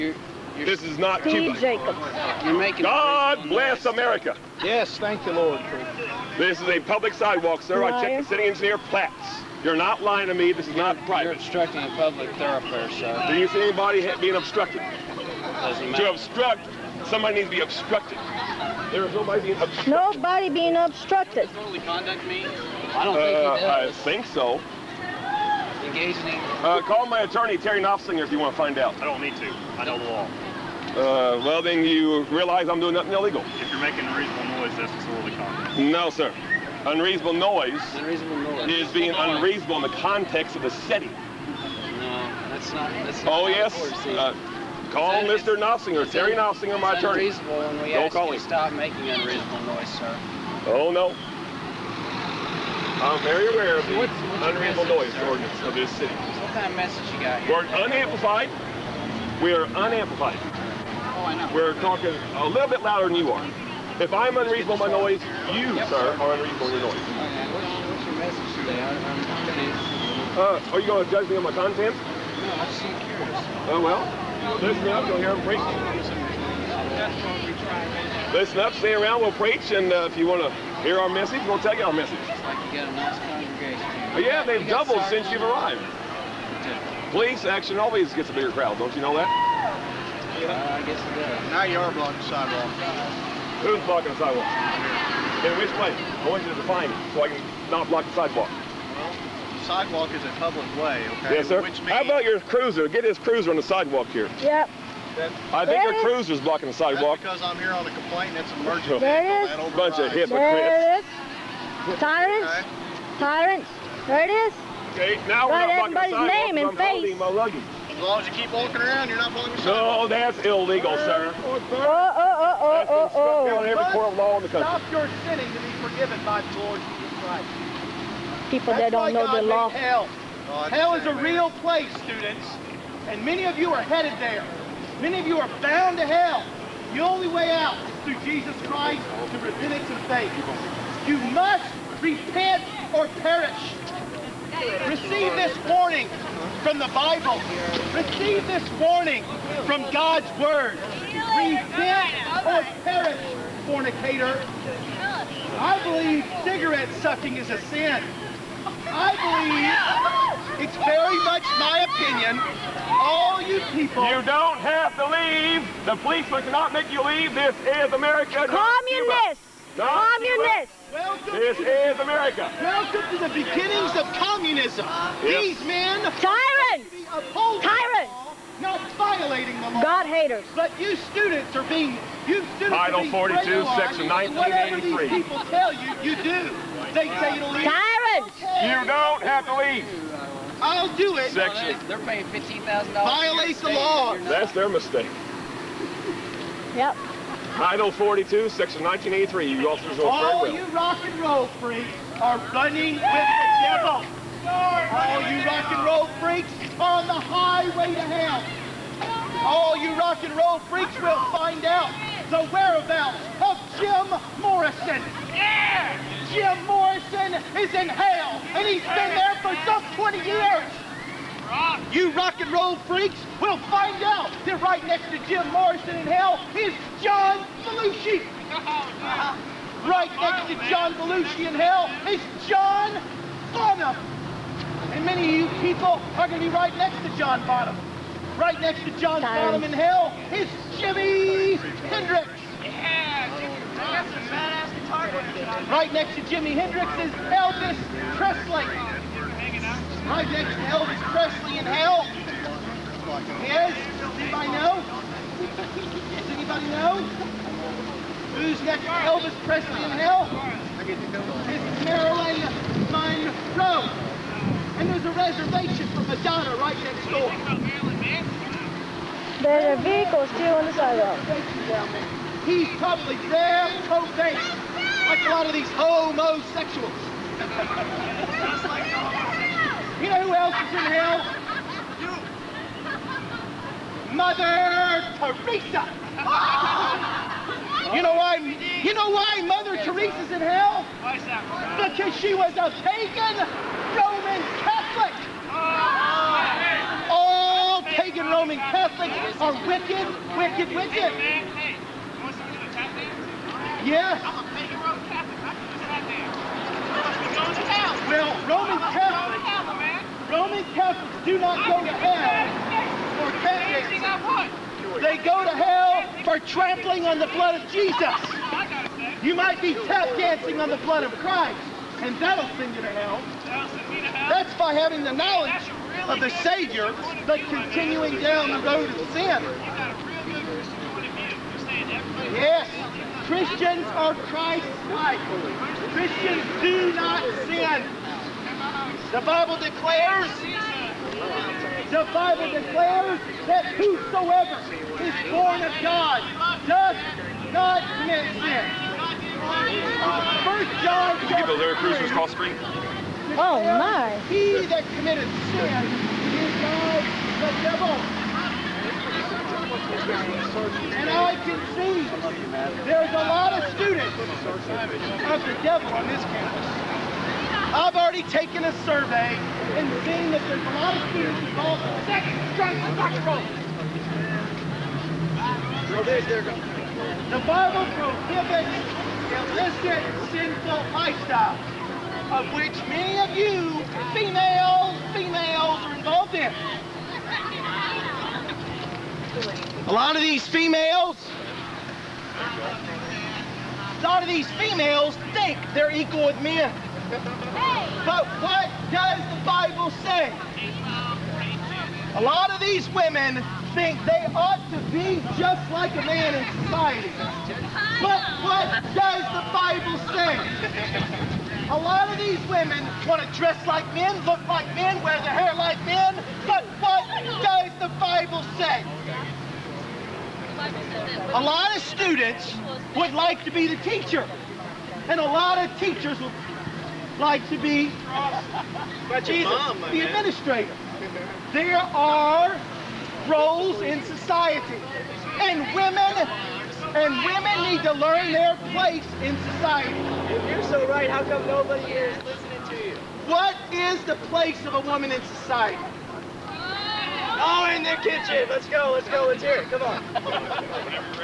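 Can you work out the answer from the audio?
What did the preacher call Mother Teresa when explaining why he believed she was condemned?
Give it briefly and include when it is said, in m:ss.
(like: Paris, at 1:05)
a pagan Roman Catholic, at 4:52.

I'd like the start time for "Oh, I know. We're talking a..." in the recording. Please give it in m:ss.
1:00.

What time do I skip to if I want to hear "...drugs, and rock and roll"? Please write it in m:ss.
6:12.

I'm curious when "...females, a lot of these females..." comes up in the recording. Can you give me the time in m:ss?
6:30.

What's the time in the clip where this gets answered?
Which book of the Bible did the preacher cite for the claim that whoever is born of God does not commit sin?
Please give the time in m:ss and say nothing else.
5:50.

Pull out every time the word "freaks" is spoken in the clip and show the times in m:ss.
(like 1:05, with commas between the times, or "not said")
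3:21, 3:26, 3:30, 3:42.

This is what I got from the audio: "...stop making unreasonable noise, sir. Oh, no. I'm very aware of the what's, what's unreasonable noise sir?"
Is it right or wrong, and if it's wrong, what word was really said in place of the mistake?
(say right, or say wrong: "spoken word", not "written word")
right.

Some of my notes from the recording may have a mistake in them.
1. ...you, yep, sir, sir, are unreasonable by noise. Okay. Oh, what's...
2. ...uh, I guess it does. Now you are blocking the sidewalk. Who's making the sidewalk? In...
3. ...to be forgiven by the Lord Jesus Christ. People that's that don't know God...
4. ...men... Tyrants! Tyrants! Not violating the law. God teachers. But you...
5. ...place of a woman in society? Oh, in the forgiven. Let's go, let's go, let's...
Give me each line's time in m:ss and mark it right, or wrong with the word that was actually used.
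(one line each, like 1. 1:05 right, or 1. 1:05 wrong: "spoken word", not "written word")
1. 1:05 right
2. 1:30 wrong: "blocking", not "making"
3. 2:05 right
4. 2:55 wrong: "haters", not "teachers"
5. 7:24 wrong: "kitchen", not "forgiven".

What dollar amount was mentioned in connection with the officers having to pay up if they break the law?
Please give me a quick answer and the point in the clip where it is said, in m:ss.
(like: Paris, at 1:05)
$15,000, at 3:12.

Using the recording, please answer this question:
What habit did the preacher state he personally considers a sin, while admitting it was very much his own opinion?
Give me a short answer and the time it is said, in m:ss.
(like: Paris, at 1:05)
cigarette sucking, at 2:36.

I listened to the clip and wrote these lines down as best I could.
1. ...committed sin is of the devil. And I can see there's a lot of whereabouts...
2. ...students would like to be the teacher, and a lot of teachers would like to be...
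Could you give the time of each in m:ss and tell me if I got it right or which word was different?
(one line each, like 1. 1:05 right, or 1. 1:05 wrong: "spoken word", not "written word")
1. 5:54 wrong: "students", not "whereabouts"
2. 7:01 right.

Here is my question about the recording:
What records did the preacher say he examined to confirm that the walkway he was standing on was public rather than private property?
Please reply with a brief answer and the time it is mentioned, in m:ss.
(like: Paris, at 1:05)
city engineer plats, at 0:08.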